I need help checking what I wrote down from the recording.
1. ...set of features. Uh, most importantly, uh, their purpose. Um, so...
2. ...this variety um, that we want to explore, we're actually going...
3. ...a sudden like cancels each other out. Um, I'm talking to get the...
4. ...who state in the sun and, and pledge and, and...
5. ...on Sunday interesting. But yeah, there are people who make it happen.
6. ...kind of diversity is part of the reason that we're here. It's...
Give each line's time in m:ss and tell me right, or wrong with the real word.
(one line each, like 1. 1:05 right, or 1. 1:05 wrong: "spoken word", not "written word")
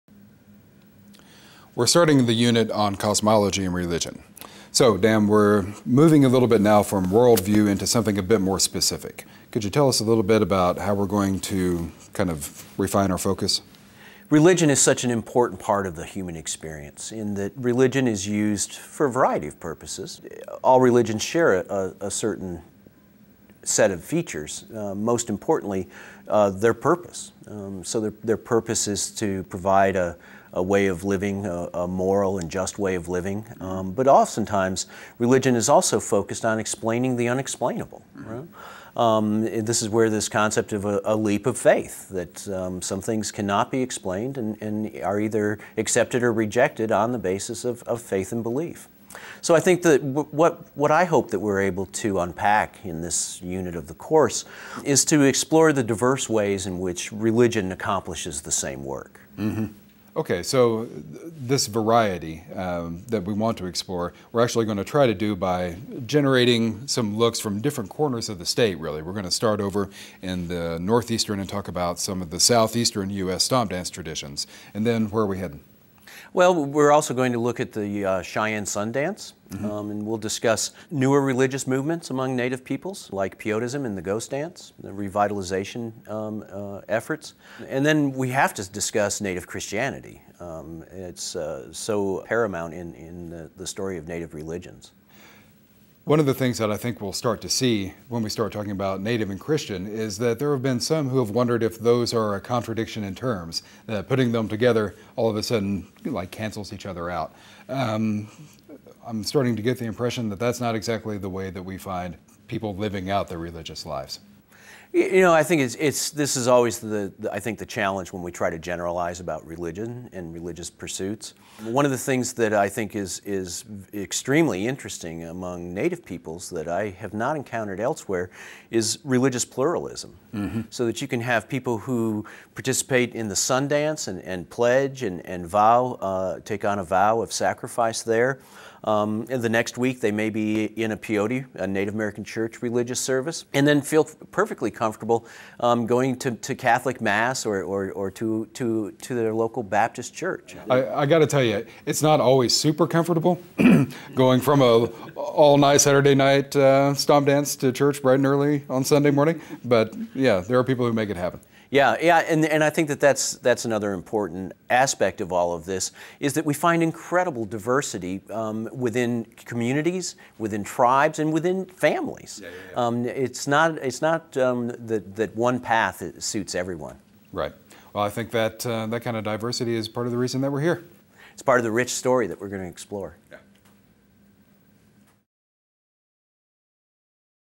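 1. 0:23 right
2. 1:01 right
3. 1:45 wrong: "starting", not "talking"
4. 2:11 wrong: "participate", not "state"
5. 2:38 wrong: "morning", not "interesting"
6. 2:59 right.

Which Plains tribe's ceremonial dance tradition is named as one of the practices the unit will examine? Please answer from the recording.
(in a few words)
Cheyenne.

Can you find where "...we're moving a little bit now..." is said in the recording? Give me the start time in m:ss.
0:05.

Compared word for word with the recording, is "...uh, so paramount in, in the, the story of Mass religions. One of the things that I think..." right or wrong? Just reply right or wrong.
wrong.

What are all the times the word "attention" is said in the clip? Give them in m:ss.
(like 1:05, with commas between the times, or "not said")
not said.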